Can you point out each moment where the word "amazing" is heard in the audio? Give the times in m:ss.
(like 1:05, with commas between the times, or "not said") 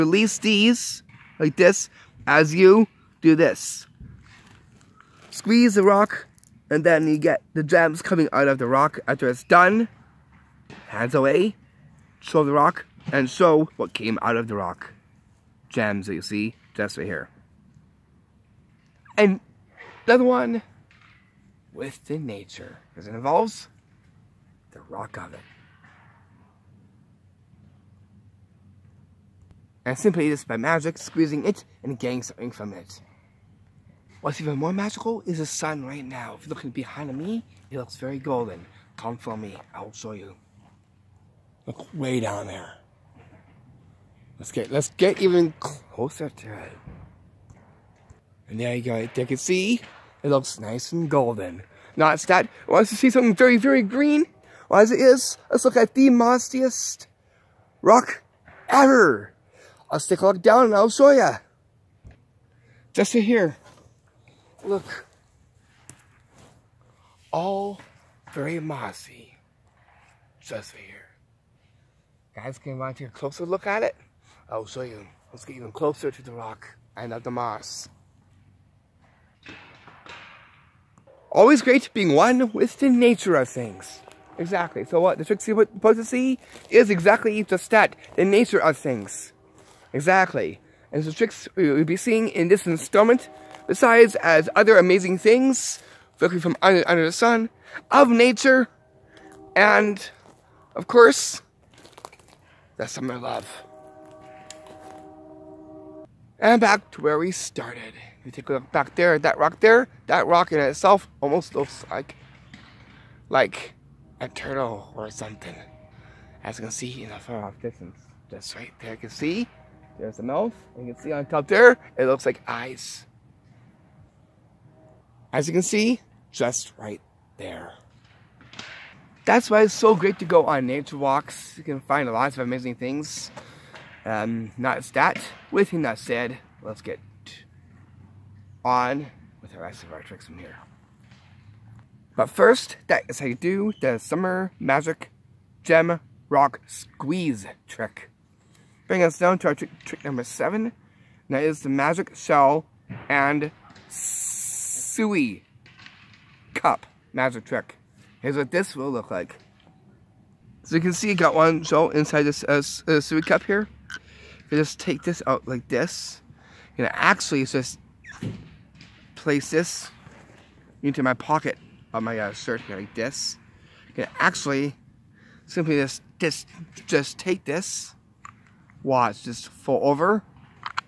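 1:34, 2:12.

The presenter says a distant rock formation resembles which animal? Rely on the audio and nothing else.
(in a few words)
Turtle.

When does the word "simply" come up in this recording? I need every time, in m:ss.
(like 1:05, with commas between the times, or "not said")
0:29, 2:55.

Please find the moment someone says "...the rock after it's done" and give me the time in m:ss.
0:08.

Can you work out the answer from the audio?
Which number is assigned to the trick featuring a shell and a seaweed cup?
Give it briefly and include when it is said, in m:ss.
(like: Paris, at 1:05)
7, at 2:30.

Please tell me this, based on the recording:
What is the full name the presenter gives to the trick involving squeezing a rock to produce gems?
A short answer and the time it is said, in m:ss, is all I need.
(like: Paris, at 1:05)
Summer Magic Gem Rock Squeeze, at 2:23.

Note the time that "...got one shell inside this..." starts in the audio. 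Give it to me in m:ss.
2:41.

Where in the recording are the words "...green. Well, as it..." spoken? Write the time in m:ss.
0:53.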